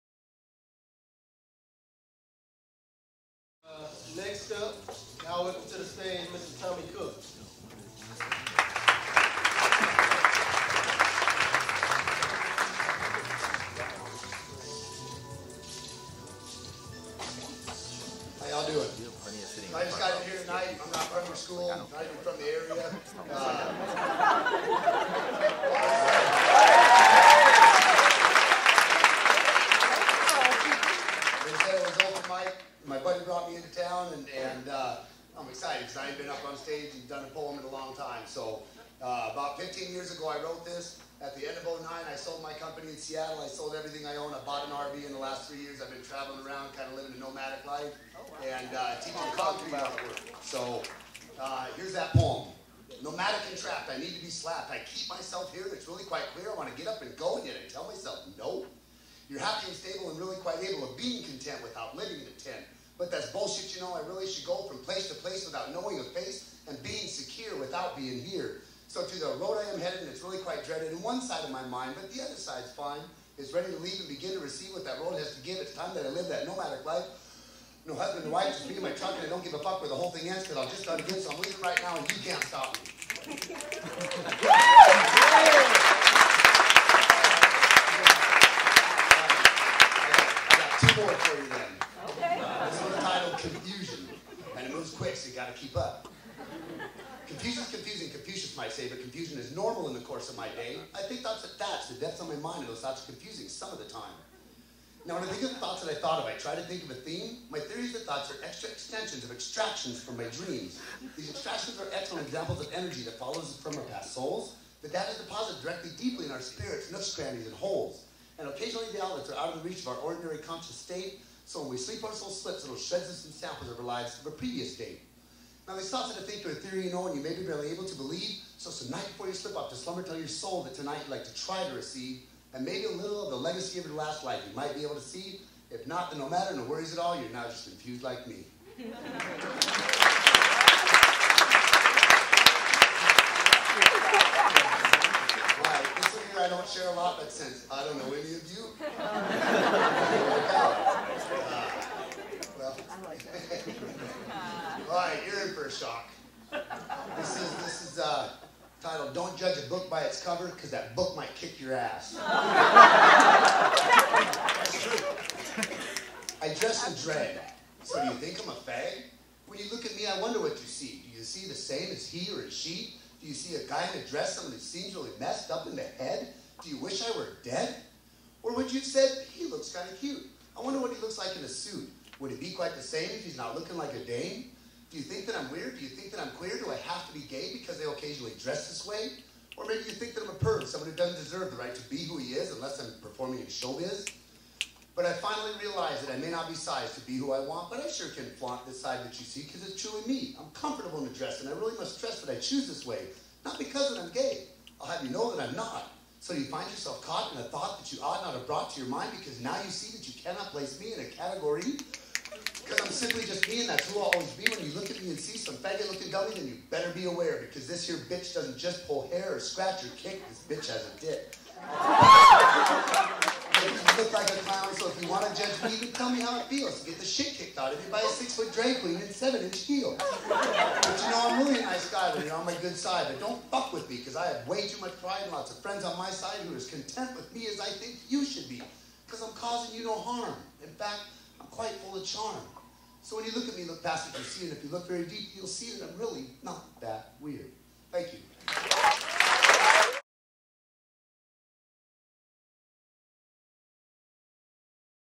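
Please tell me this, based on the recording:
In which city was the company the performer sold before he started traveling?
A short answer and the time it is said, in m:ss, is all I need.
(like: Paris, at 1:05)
Seattle, at 0:42.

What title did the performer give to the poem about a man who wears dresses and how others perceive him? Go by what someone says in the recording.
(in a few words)
Don't Judge a Book by Its Cover.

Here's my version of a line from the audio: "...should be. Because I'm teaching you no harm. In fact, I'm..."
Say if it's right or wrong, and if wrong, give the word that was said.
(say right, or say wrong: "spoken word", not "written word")
wrong: "causing", not "teaching".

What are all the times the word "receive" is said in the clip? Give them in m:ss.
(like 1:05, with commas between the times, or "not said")
1:14, 2:11.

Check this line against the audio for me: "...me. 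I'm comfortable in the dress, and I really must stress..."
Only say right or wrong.
right.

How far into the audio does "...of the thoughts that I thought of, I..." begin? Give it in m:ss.
1:45.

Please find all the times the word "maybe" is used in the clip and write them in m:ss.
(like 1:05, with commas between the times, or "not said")
2:12, 3:09.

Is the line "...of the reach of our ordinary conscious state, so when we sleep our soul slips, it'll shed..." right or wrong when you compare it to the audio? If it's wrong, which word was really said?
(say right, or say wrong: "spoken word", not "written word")
right.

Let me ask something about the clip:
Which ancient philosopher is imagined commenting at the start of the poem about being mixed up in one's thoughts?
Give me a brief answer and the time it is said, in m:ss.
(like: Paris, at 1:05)
Confucius, at 1:38.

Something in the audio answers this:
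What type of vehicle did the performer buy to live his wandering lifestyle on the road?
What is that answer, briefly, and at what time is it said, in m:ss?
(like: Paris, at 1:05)
RV, at 0:44.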